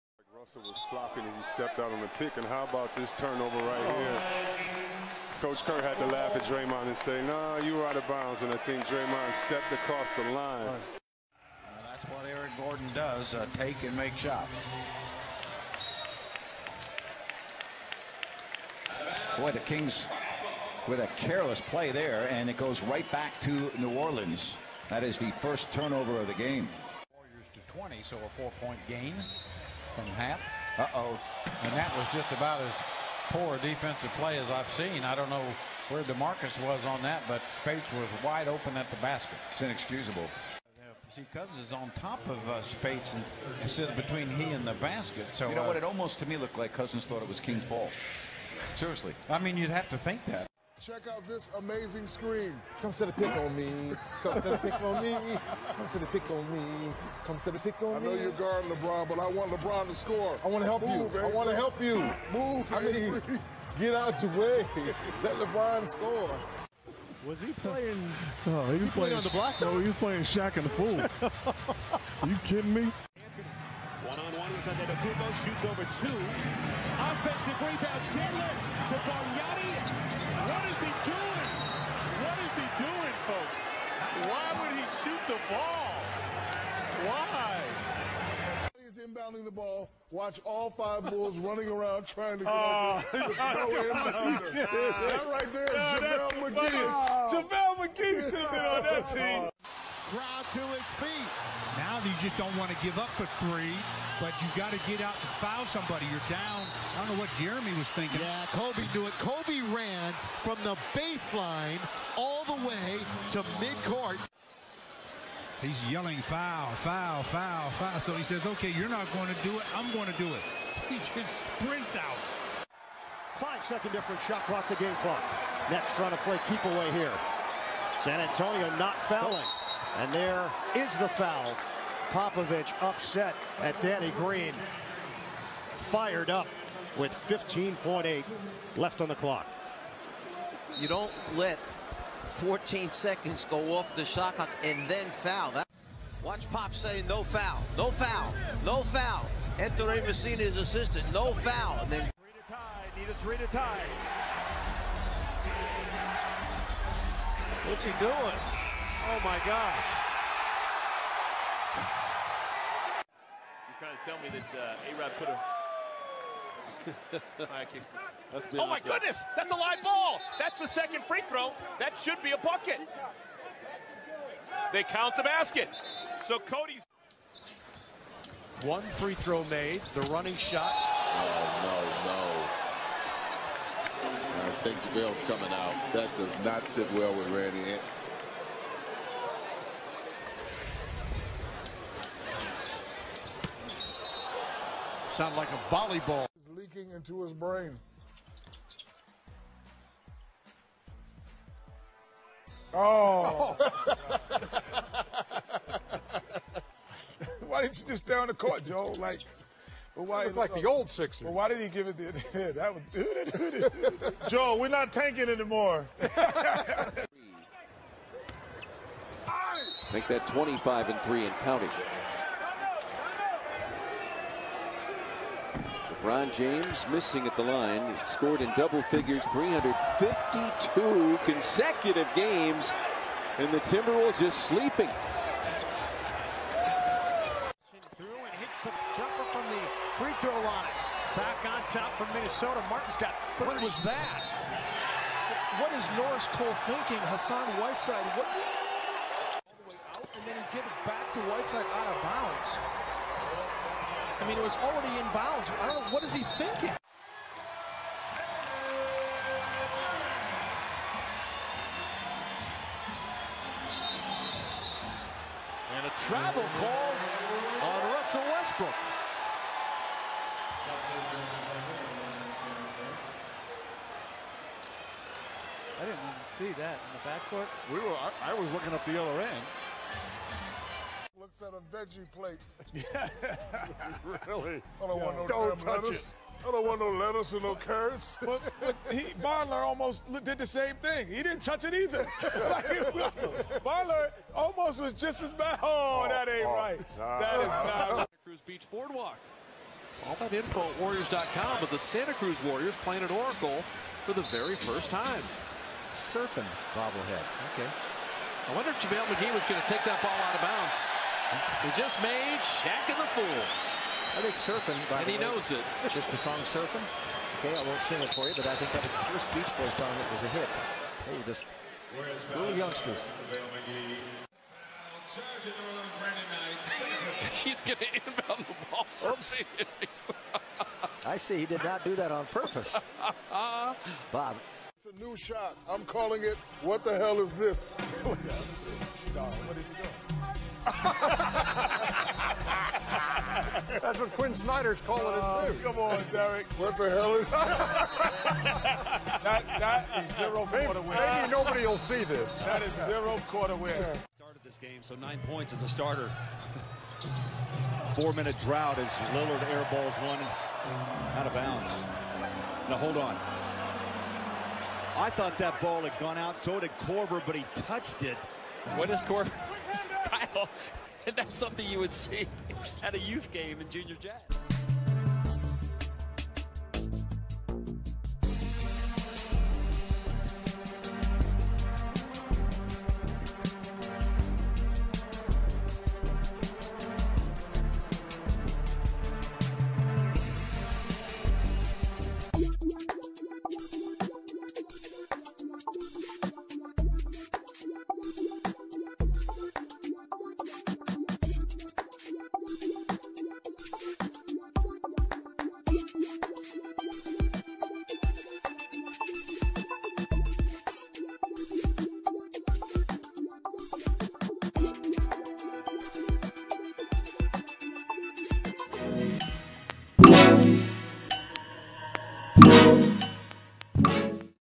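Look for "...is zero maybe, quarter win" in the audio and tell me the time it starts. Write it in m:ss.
5:50.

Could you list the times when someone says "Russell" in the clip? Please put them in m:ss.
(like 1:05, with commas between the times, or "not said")
0:00, 4:27.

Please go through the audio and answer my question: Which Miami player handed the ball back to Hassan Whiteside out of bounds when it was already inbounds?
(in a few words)
Norris Cole.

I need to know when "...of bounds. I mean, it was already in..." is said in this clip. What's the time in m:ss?
4:11.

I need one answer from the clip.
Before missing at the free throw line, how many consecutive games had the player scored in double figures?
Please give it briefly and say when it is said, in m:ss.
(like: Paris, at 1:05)
352, at 3:49.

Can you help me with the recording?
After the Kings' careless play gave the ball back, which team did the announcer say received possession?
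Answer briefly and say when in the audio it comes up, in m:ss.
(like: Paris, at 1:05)
New Orleans, at 0:23.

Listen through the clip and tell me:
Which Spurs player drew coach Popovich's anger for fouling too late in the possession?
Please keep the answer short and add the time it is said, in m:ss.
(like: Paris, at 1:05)
Danny Green, at 2:13.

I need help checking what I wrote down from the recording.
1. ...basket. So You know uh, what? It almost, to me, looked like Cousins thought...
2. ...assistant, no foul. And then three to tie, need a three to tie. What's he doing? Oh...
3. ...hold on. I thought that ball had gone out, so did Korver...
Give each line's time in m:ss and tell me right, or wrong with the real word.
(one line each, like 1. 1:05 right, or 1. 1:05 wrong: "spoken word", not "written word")
1. 0:44 right
2. 2:30 right
3. 6:02 right.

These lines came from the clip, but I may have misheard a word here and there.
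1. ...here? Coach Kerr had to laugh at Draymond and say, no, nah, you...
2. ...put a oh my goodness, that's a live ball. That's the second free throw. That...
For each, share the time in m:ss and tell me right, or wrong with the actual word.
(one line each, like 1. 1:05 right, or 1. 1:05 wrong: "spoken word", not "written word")
1. 0:03 right
2. 2:45 right.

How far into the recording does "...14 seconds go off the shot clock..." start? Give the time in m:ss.
2:22.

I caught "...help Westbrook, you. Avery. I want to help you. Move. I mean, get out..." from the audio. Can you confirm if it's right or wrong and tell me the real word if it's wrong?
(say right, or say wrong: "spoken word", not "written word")
wrong: "Move", not "Westbrook".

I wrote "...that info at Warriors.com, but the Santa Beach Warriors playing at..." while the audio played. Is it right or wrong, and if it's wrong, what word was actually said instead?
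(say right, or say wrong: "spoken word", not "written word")
wrong: "Cruz", not "Beach".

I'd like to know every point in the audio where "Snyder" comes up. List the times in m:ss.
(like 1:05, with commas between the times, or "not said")
5:44.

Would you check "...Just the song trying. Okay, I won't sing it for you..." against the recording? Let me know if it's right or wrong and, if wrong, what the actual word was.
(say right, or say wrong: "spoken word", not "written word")
wrong: "surfing", not "trying".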